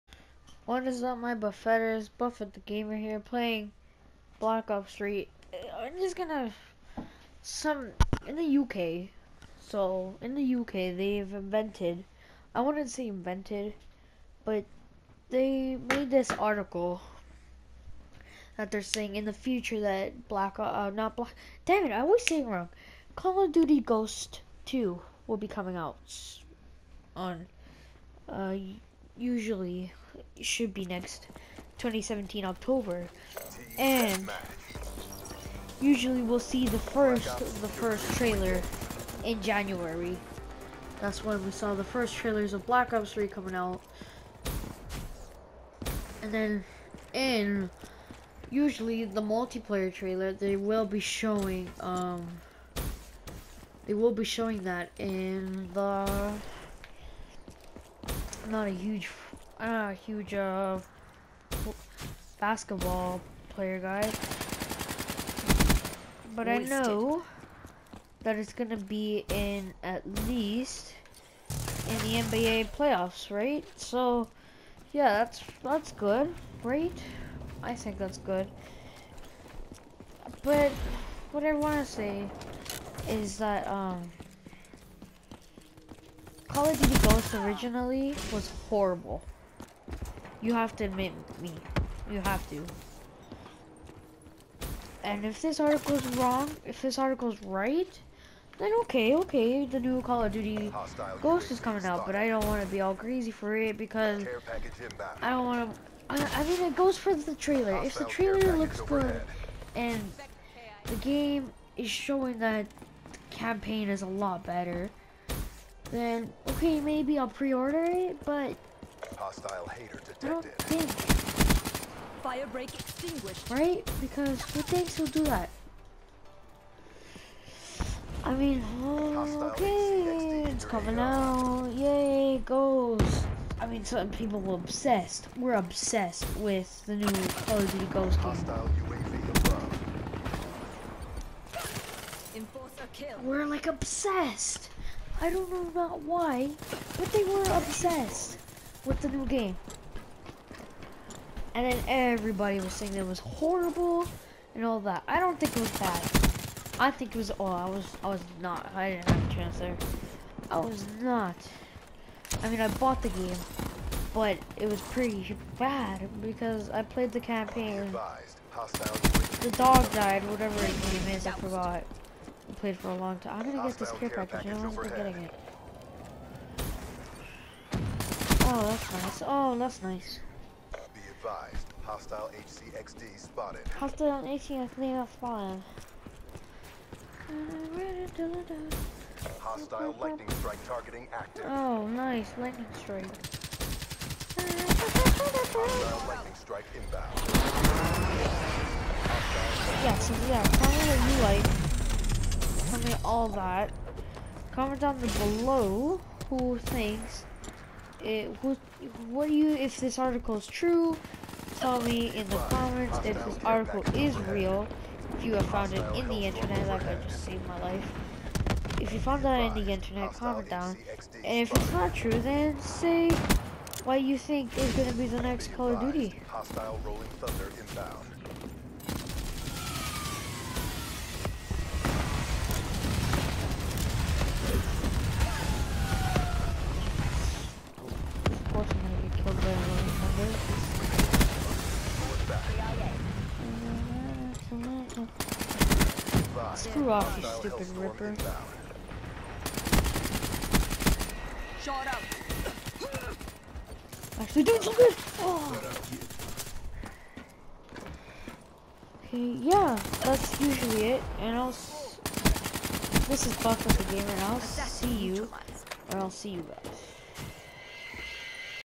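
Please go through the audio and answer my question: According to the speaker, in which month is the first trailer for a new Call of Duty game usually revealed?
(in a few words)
January.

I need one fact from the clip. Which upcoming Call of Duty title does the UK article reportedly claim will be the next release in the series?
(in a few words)
Call of Duty Ghost 2.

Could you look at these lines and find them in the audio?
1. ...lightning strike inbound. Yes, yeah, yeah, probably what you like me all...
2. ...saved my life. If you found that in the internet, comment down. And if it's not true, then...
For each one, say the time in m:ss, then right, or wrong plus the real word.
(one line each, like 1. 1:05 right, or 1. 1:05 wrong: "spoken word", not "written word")
1. 3:16 right
2. 3:37 right.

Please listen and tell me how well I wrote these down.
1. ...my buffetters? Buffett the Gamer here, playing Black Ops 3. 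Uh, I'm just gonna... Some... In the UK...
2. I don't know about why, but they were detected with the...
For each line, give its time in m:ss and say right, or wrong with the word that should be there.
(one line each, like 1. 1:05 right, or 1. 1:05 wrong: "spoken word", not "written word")
1. 0:01 right
2. 2:25 wrong: "obsessed", not "detected".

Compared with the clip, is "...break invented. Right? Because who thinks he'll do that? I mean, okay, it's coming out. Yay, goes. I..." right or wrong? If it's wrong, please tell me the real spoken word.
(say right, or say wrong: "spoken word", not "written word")
wrong: "extinguished", not "invented".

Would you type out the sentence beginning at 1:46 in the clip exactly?
I, I, mean, it goes for the trailer.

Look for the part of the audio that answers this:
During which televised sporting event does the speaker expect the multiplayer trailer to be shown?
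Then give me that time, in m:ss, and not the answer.
1:12.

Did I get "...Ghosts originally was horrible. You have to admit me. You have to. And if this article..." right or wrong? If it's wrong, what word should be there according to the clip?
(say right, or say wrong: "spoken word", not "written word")
right.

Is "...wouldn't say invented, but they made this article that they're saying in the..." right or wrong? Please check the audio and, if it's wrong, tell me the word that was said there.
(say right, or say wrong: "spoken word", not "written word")
right.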